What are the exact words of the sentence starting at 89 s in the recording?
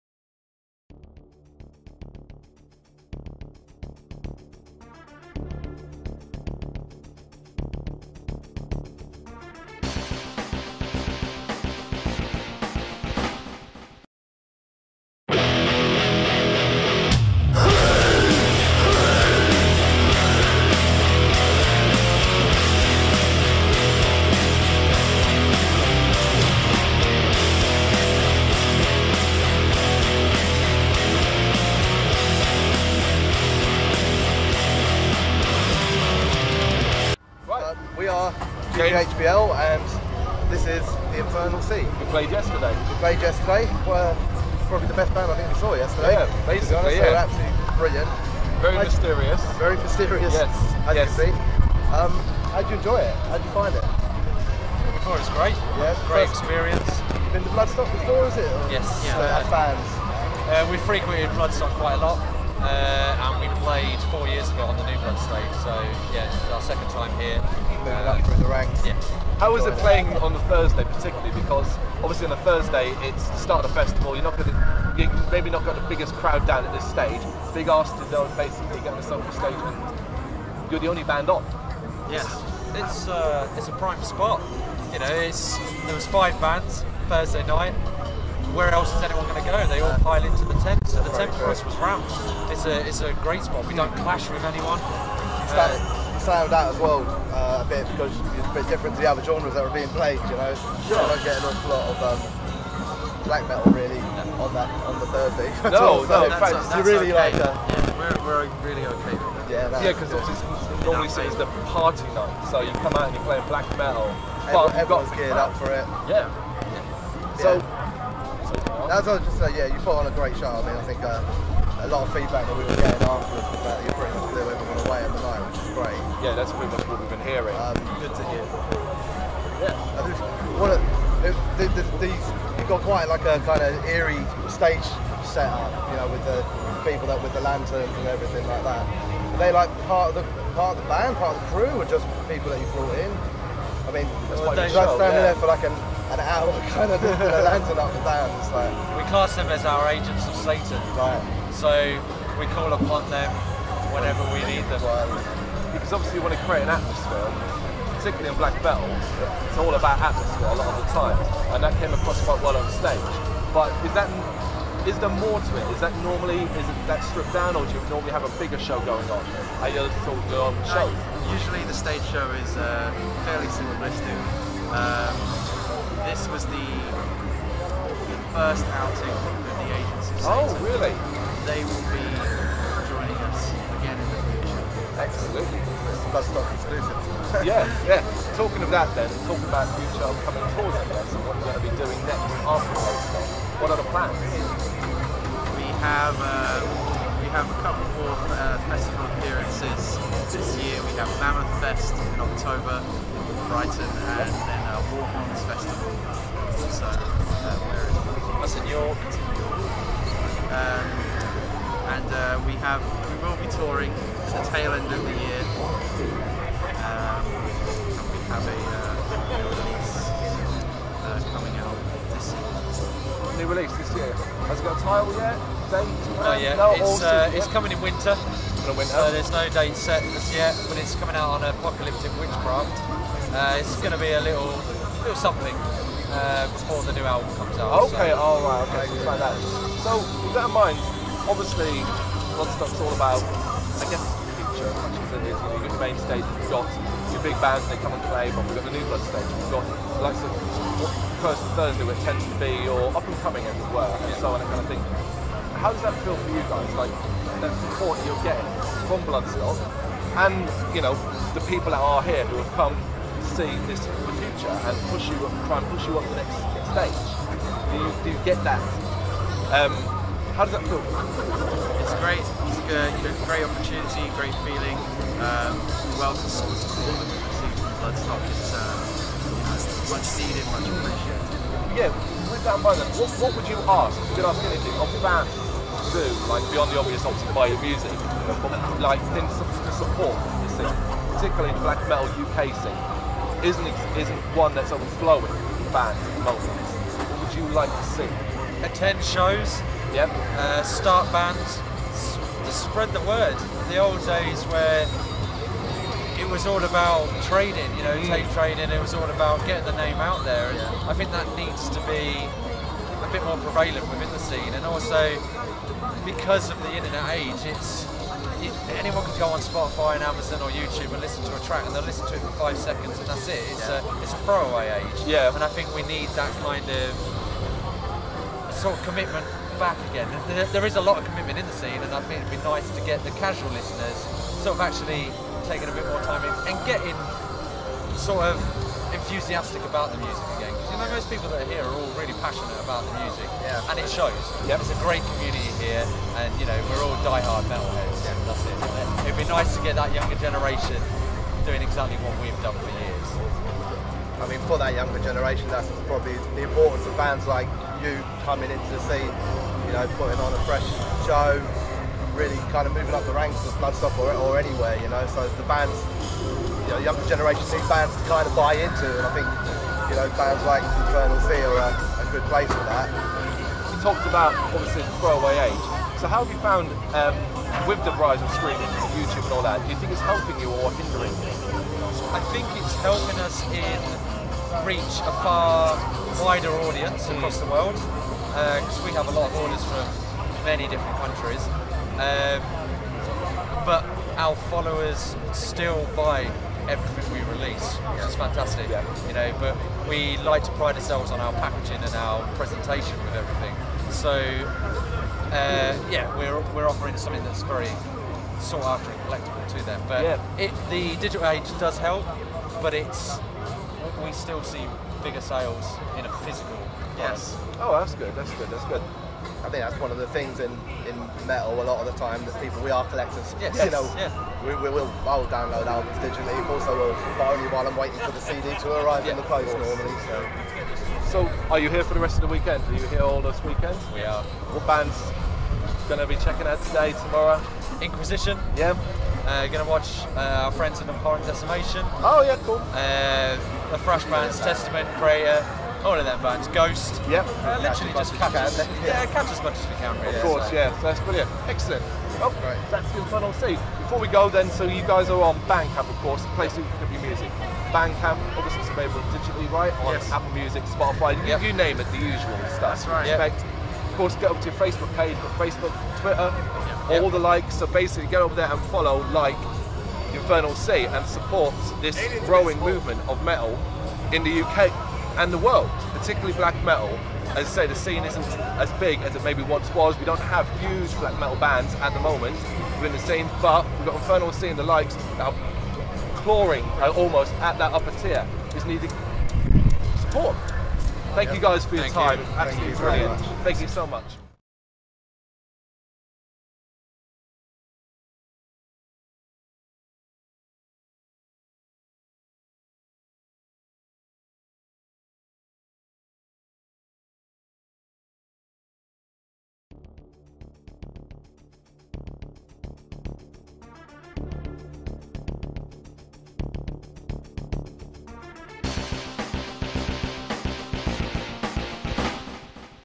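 They all pile into the tent, so the tent for us was rammed.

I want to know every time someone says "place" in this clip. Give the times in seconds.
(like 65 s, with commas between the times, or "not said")
372 s, 456 s.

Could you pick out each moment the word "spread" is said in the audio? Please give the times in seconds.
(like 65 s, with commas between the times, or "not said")
302 s.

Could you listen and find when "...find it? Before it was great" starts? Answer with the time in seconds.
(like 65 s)
53 s.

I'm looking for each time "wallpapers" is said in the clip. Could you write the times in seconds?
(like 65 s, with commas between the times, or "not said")
not said.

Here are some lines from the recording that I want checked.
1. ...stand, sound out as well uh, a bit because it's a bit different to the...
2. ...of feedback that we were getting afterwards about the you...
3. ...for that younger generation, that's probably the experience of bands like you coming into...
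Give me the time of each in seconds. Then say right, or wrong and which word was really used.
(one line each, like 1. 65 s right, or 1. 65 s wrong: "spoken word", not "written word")
1. 95 s right
2. 122 s right
3. 354 s wrong: "importance", not "experience".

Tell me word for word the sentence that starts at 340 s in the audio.
Because you know, most people that are here are all really passionate about the music, yeah.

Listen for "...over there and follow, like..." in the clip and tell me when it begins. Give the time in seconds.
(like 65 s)
468 s.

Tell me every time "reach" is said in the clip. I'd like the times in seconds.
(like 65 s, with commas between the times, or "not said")
384 s.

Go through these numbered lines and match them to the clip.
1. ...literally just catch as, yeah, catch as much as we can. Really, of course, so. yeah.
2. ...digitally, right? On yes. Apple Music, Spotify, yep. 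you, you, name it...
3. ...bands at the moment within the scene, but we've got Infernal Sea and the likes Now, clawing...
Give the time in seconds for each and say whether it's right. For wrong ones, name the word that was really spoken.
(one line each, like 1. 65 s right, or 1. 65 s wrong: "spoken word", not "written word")
1. 447 s right
2. 459 s right
3. 481 s right.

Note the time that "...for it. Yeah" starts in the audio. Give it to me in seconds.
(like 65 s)
115 s.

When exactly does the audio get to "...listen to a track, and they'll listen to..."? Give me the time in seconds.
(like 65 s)
321 s.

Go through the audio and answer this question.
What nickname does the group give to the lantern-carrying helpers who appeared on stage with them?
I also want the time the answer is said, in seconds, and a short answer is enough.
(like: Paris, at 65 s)
Agents of Satan, at 149 s.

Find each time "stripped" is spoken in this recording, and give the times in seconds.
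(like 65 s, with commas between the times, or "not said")
167 s.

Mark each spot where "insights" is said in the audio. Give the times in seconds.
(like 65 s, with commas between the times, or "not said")
not said.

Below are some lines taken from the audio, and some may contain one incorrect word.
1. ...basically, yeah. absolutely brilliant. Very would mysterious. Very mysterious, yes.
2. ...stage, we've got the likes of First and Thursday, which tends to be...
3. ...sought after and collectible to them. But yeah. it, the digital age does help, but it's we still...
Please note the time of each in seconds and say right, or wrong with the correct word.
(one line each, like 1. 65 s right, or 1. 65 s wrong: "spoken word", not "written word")
1. 46 s right
2. 249 s right
3. 408 s right.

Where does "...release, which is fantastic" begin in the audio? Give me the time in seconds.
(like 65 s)
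397 s.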